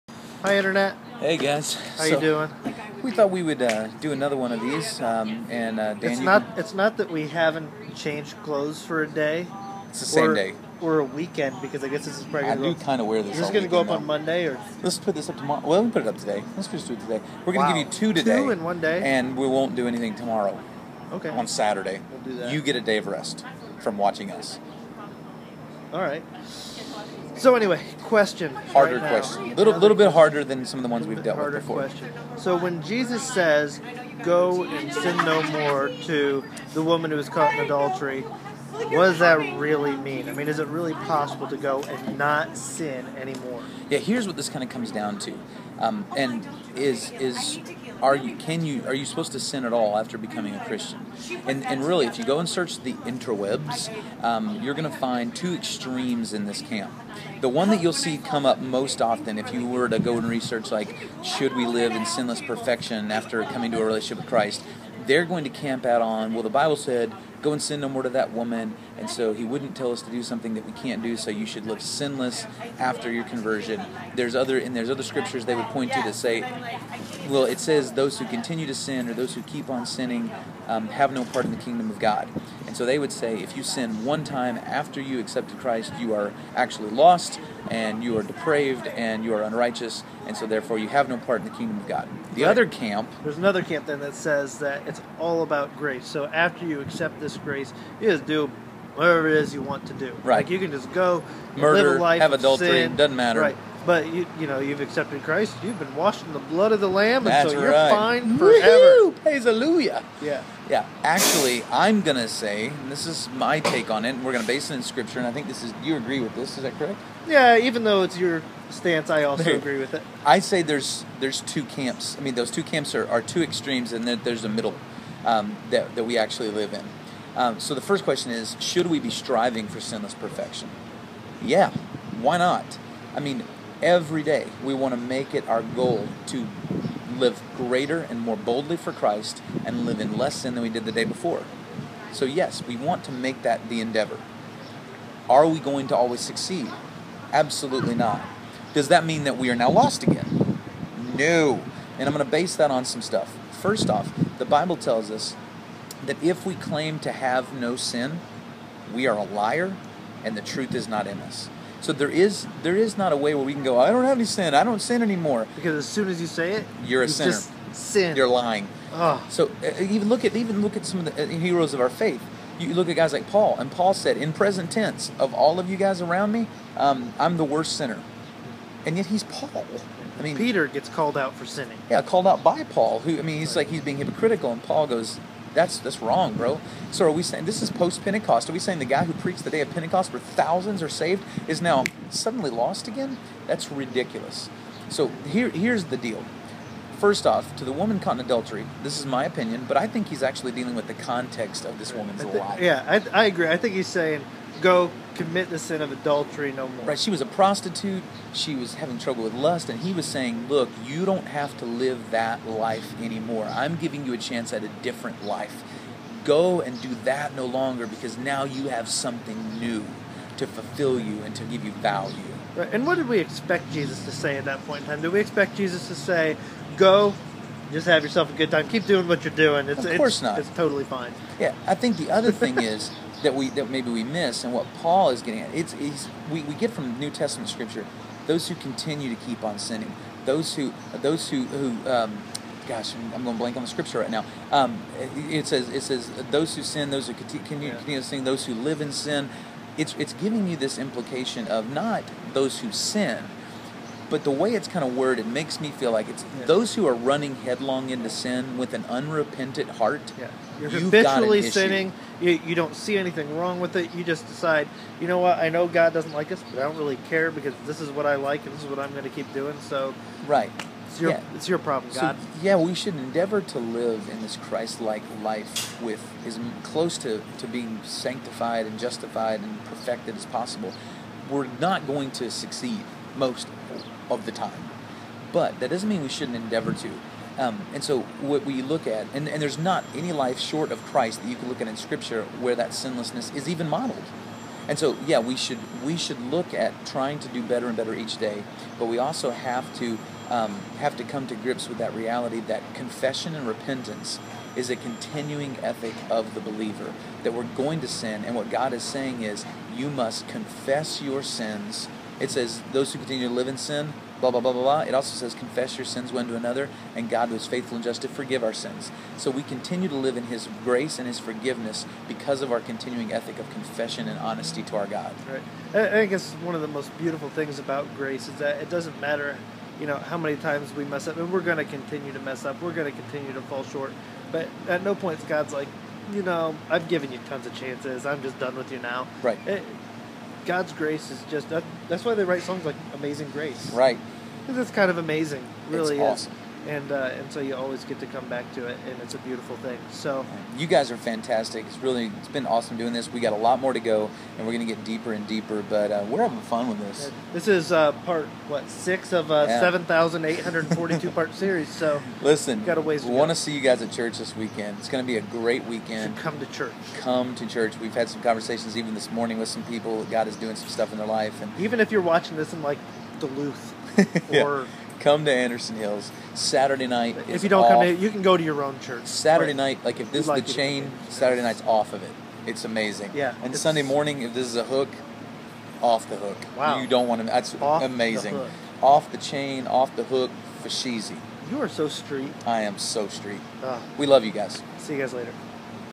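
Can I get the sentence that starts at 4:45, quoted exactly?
But that doesn't mean we shouldn't endeavor to.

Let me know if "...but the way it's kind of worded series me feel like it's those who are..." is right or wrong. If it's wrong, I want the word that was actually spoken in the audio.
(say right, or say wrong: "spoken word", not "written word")
wrong: "makes", not "series".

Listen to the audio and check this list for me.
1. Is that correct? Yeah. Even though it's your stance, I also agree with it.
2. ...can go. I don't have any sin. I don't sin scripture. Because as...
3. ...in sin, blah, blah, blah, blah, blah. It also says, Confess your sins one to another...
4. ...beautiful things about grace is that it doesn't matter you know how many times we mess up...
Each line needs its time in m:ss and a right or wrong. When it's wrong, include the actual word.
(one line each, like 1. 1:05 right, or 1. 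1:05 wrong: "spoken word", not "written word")
1. 1:56 right
2. 2:43 wrong: "anymore", not "scripture"
3. 5:13 right
4. 5:26 right.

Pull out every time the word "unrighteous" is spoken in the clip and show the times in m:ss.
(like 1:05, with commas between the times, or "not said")
1:29.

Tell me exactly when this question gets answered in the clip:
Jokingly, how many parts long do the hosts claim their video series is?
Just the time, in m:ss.
5:59.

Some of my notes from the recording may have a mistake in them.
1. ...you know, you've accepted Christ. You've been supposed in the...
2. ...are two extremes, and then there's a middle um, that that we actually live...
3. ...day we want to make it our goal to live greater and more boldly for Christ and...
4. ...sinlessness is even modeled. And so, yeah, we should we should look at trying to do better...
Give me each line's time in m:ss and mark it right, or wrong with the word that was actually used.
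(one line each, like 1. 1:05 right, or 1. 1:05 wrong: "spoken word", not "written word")
1. 1:44 wrong: "washed", not "supposed"
2. 2:03 right
3. 2:14 right
4. 4:52 right.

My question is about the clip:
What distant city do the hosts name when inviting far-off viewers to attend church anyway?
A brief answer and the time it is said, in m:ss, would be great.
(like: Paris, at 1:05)
Duluth, at 6:13.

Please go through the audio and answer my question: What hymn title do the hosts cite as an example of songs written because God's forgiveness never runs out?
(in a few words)
Amazing Grace.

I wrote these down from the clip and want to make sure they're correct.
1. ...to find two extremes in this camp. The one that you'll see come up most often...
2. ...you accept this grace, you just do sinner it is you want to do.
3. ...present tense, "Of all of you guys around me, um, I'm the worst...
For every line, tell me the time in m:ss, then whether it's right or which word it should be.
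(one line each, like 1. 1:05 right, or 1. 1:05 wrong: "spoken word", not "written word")
1. 0:54 right
2. 1:36 wrong: "whatever", not "sinner"
3. 2:54 right.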